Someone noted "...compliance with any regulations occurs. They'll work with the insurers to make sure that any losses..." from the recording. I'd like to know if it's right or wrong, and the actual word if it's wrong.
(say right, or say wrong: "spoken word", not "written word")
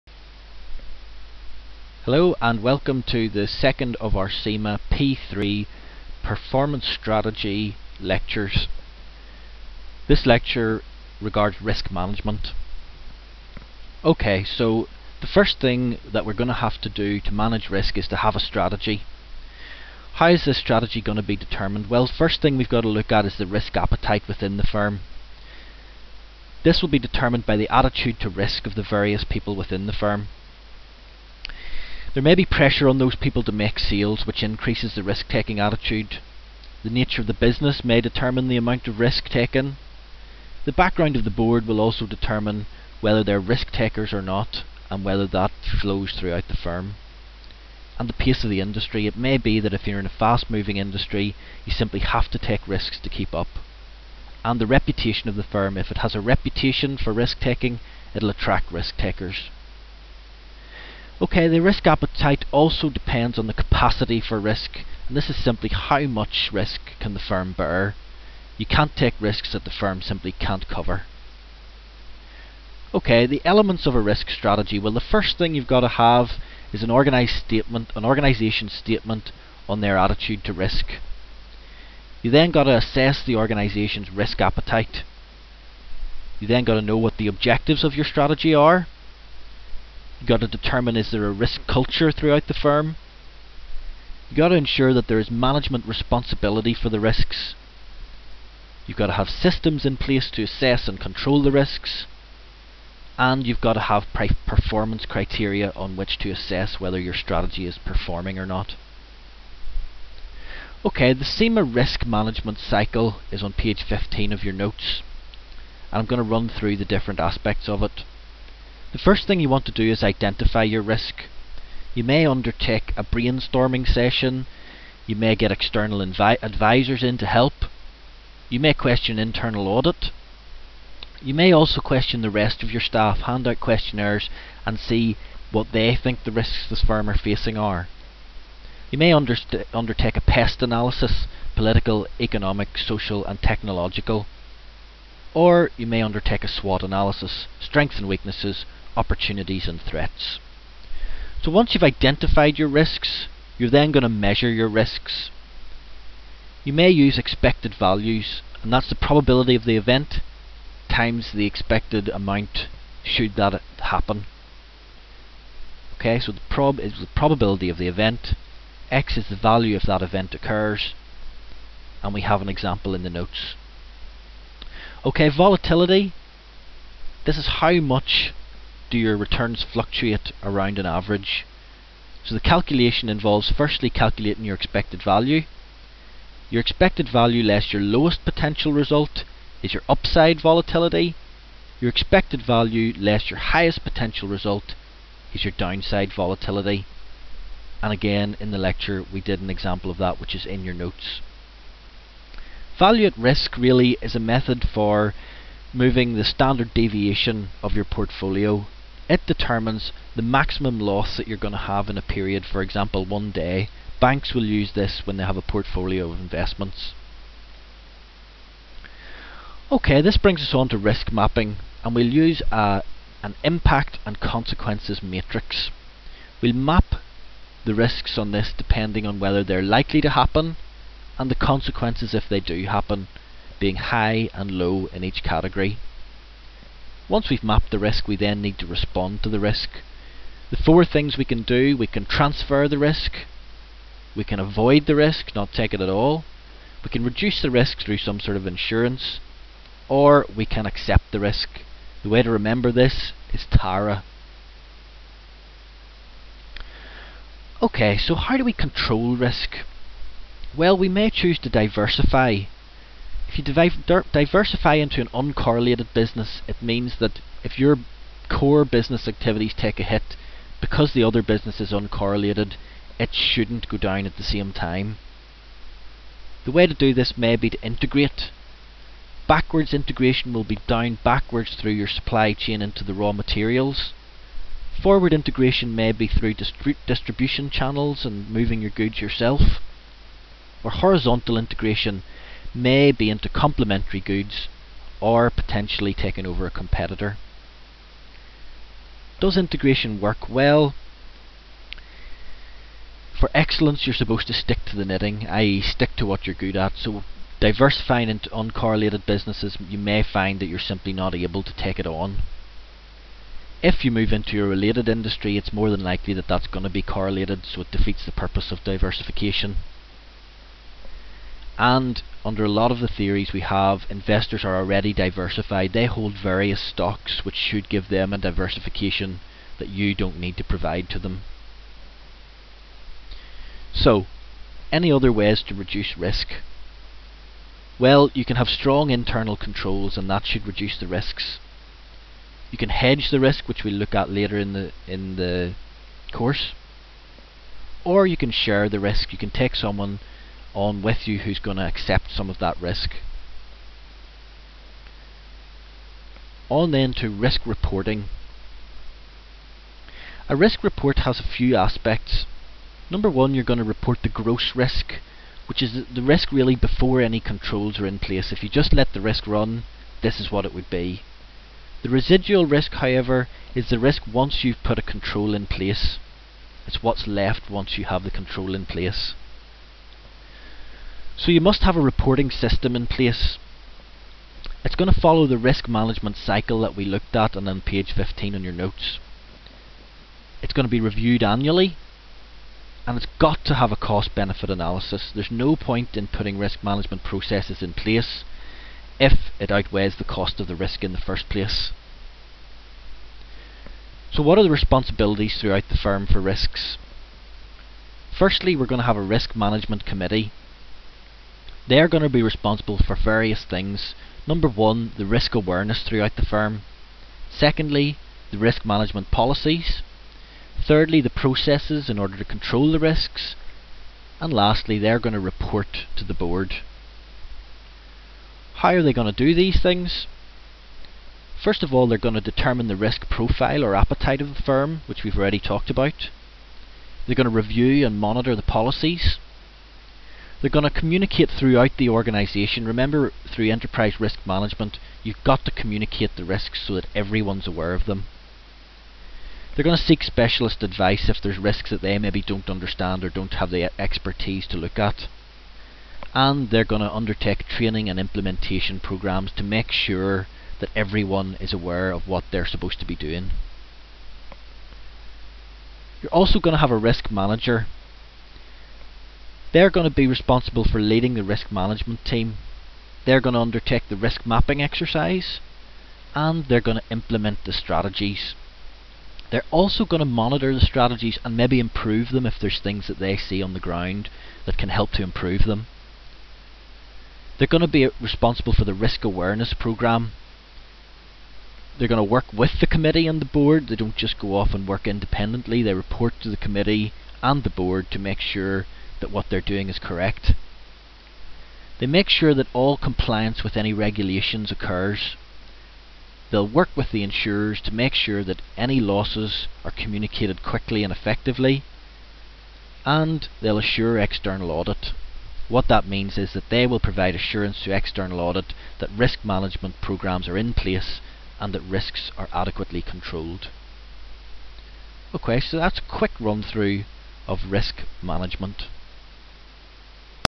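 right.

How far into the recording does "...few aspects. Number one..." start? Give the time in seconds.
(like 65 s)
361 s.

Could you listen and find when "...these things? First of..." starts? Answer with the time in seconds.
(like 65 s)
429 s.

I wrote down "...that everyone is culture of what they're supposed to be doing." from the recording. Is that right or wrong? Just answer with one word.
wrong.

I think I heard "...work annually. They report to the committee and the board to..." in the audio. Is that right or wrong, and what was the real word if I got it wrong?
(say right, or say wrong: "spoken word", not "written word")
wrong: "independently", not "annually".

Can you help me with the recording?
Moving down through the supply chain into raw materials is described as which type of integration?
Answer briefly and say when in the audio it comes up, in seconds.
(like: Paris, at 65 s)
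Backwards integration, at 279 s.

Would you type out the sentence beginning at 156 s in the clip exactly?
You may use expected values, and that's the probability of the event times the expected amount should that happen.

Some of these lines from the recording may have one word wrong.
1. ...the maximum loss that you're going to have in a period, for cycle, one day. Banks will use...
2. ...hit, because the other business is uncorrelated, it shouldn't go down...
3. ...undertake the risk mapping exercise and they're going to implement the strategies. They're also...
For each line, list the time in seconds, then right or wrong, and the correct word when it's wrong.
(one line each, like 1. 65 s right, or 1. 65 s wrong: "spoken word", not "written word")
1. 210 s wrong: "example", not "cycle"
2. 269 s right
3. 473 s right.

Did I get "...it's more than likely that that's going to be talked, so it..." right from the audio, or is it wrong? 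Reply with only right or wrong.
wrong.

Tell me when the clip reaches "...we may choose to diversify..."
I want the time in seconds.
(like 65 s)
260 s.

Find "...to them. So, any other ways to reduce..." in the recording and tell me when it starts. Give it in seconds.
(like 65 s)
330 s.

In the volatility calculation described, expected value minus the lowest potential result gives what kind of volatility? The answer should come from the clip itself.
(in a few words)
Upside volatility.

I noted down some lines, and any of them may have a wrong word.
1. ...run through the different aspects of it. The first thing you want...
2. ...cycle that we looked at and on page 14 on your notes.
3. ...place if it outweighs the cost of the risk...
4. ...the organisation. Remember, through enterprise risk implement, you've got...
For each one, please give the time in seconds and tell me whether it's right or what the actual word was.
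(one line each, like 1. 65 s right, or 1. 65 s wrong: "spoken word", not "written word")
1. 116 s right
2. 386 s wrong: "15", not "14"
3. 397 s right
4. 441 s wrong: "management", not "implement".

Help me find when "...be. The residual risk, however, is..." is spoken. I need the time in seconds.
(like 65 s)
370 s.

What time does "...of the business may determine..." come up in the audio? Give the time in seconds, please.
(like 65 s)
37 s.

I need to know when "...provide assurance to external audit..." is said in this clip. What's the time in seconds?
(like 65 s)
516 s.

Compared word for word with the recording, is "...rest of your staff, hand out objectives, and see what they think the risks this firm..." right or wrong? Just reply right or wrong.
wrong.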